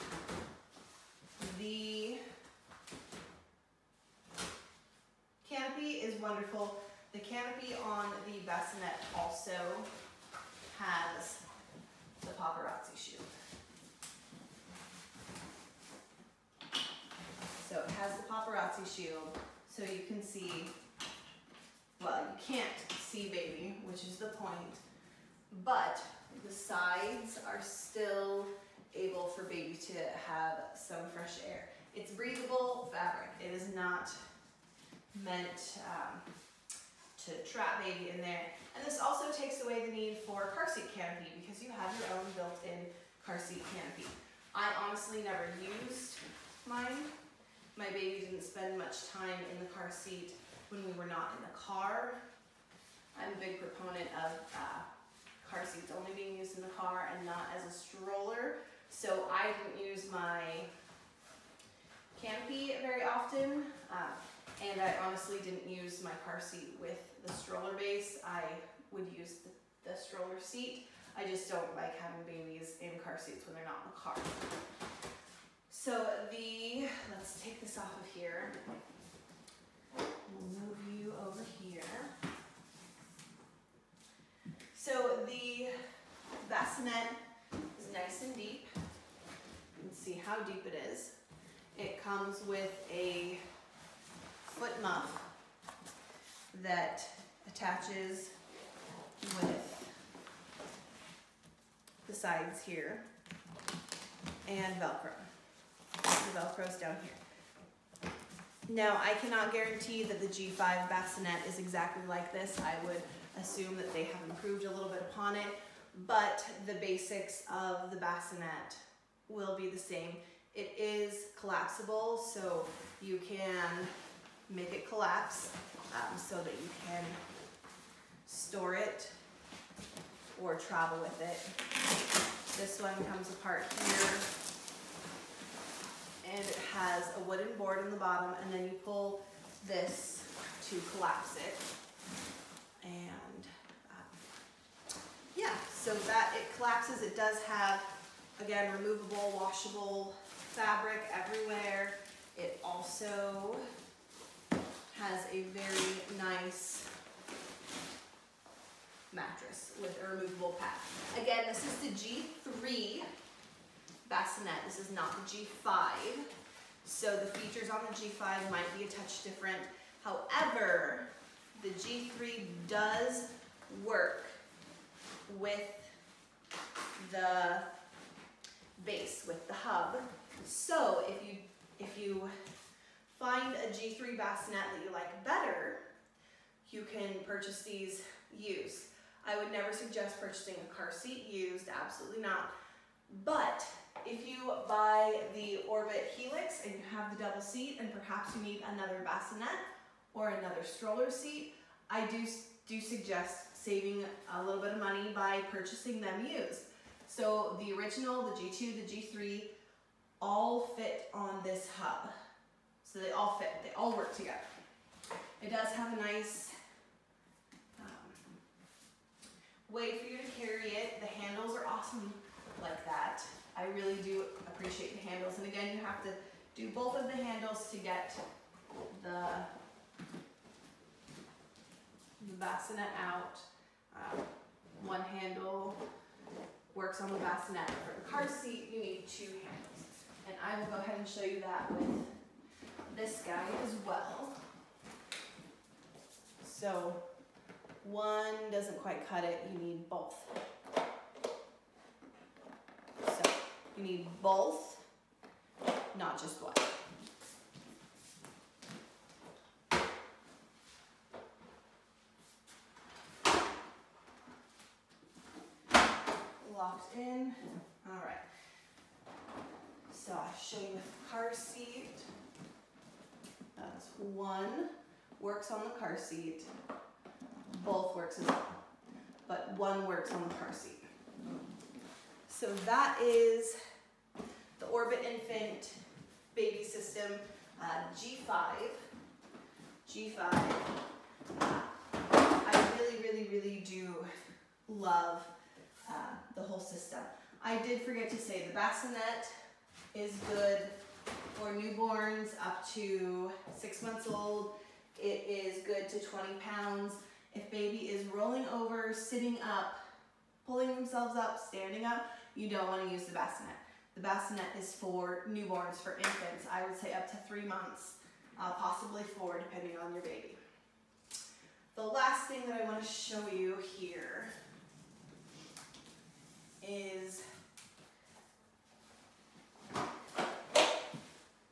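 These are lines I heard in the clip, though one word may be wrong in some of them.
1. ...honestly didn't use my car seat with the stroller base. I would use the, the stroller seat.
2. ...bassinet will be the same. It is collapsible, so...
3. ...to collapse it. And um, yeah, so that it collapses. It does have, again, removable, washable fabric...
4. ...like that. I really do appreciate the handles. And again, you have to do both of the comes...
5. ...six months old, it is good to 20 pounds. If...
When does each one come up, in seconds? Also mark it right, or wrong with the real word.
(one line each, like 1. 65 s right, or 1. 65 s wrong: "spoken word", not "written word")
1. 65 s right
2. 117 s right
3. 140 s right
4. 222 s wrong: "handles", not "comes"
5. 303 s right.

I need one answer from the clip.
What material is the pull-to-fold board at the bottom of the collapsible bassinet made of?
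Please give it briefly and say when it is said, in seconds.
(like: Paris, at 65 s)
wooden, at 137 s.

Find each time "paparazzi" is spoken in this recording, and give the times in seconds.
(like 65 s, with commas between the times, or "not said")
12 s, 18 s.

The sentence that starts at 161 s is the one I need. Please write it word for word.
Again, this is the G3 bassinet.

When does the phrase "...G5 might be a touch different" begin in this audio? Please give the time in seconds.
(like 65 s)
167 s.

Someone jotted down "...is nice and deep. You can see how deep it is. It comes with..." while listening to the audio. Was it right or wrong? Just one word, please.
right.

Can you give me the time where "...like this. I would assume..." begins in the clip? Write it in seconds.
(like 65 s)
112 s.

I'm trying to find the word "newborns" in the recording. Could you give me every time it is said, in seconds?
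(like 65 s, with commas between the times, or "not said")
301 s, 315 s.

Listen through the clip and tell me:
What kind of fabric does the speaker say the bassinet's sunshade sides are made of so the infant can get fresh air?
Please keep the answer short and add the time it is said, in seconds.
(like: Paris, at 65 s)
breathable fabric, at 32 s.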